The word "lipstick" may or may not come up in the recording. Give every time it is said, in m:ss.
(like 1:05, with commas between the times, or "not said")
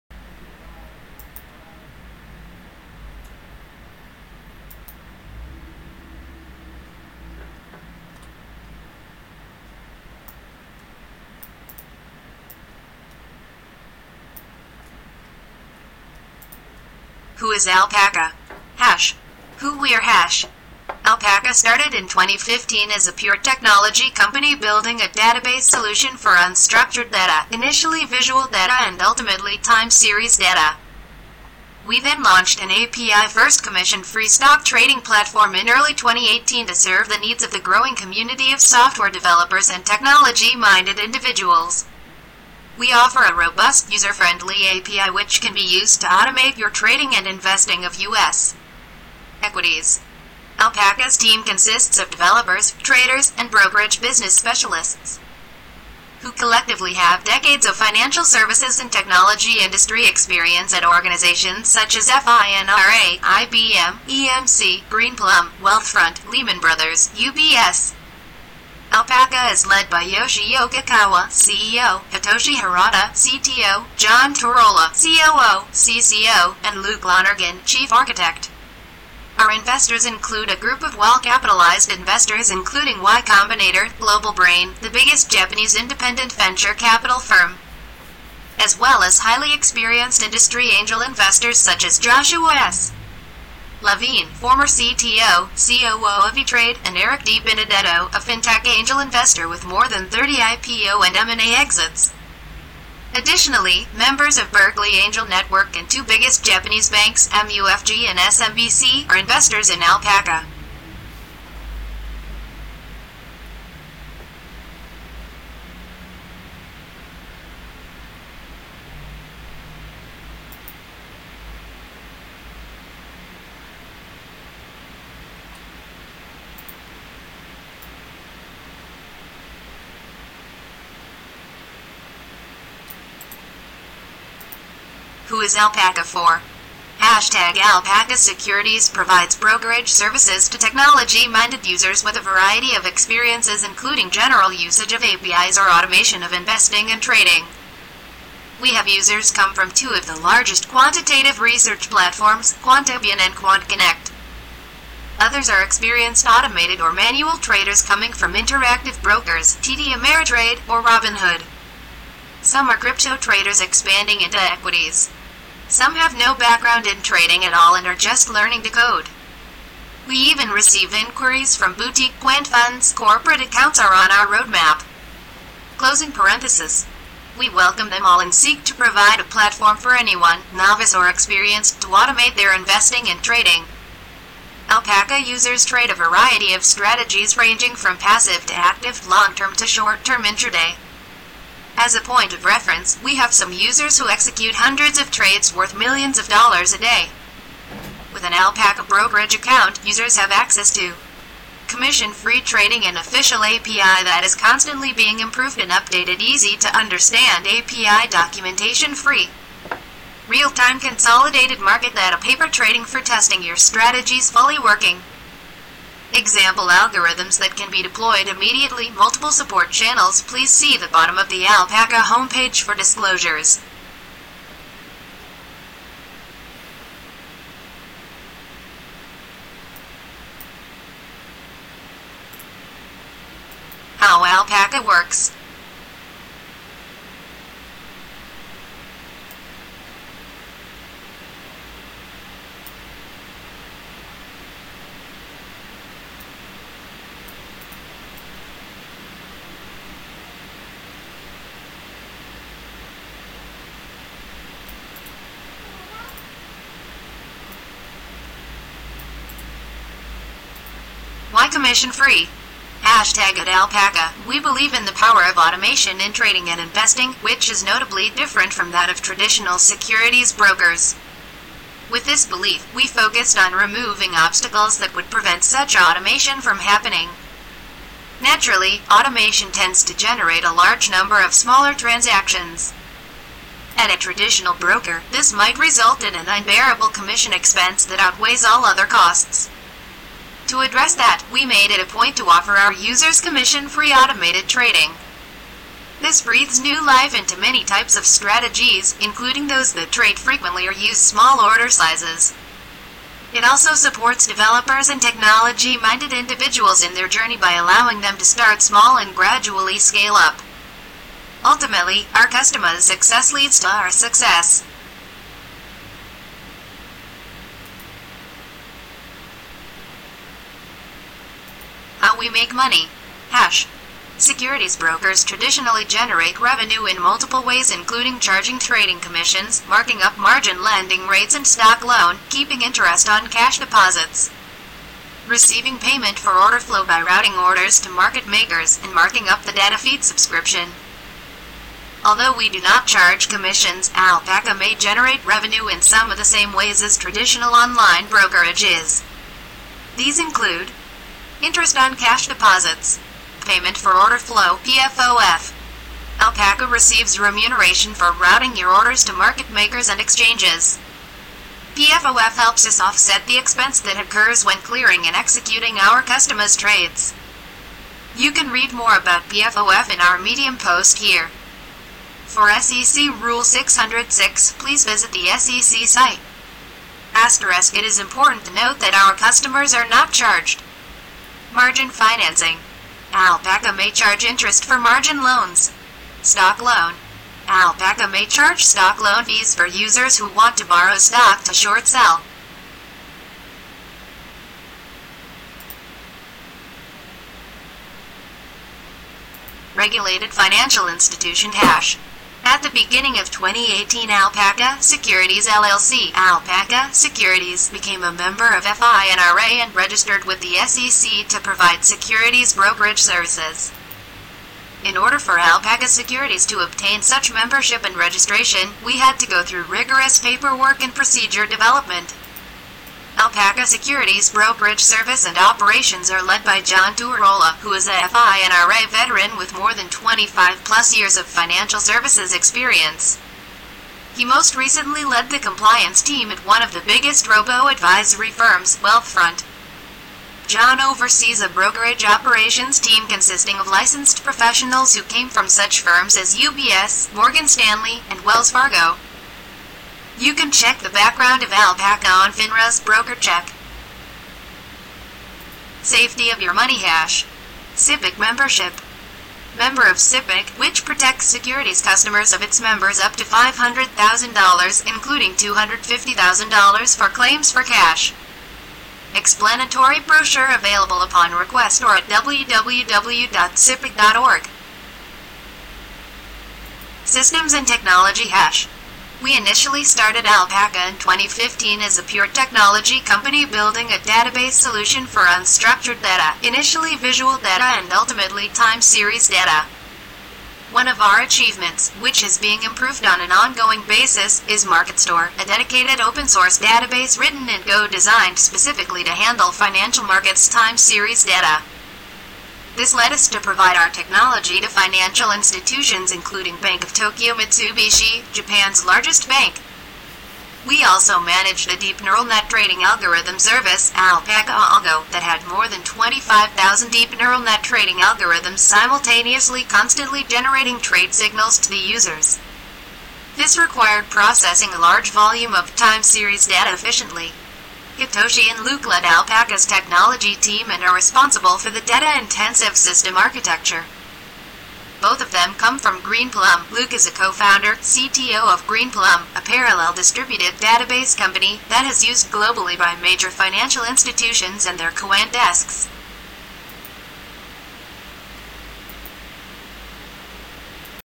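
not said.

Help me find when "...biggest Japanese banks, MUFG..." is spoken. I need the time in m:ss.
1:46.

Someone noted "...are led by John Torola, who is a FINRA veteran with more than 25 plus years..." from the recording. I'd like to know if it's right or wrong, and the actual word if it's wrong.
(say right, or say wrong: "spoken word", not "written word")
right.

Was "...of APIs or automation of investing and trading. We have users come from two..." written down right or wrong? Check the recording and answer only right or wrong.
right.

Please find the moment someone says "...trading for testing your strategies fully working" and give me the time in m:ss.
3:32.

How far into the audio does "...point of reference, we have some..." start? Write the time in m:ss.
3:12.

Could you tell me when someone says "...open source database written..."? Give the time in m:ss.
8:16.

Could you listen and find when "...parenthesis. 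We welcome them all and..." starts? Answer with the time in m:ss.
2:56.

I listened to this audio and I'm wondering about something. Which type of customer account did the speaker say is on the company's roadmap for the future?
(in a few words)
Corporate accounts.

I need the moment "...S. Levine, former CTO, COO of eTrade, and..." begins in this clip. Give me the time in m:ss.
1:32.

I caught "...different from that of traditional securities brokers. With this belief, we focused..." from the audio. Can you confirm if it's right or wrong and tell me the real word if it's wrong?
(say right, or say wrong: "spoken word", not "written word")
right.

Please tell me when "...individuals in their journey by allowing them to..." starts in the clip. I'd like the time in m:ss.
5:06.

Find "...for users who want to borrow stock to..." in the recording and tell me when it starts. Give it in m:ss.
6:29.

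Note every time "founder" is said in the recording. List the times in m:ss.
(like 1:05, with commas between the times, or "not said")
8:57.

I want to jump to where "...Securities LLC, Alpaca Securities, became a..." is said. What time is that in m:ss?
6:44.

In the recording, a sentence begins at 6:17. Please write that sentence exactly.
Asterisk It is important to note that our customers are not charged Margin financing.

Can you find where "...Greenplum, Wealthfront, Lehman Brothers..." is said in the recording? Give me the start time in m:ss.
1:04.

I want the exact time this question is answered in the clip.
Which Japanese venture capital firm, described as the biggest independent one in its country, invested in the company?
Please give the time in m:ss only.
1:24.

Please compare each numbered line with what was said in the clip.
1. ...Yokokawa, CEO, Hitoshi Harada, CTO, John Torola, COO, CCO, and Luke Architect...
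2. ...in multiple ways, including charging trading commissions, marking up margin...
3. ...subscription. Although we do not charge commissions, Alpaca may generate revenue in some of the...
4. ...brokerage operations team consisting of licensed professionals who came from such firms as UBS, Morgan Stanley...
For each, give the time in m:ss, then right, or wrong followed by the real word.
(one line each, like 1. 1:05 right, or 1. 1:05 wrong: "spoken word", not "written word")
1. 1:10 wrong: "Lonergan", not "Architect"
2. 5:26 right
3. 5:40 right
4. 7:21 right.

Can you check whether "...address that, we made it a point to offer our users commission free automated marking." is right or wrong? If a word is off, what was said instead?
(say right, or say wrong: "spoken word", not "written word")
wrong: "trading", not "marking".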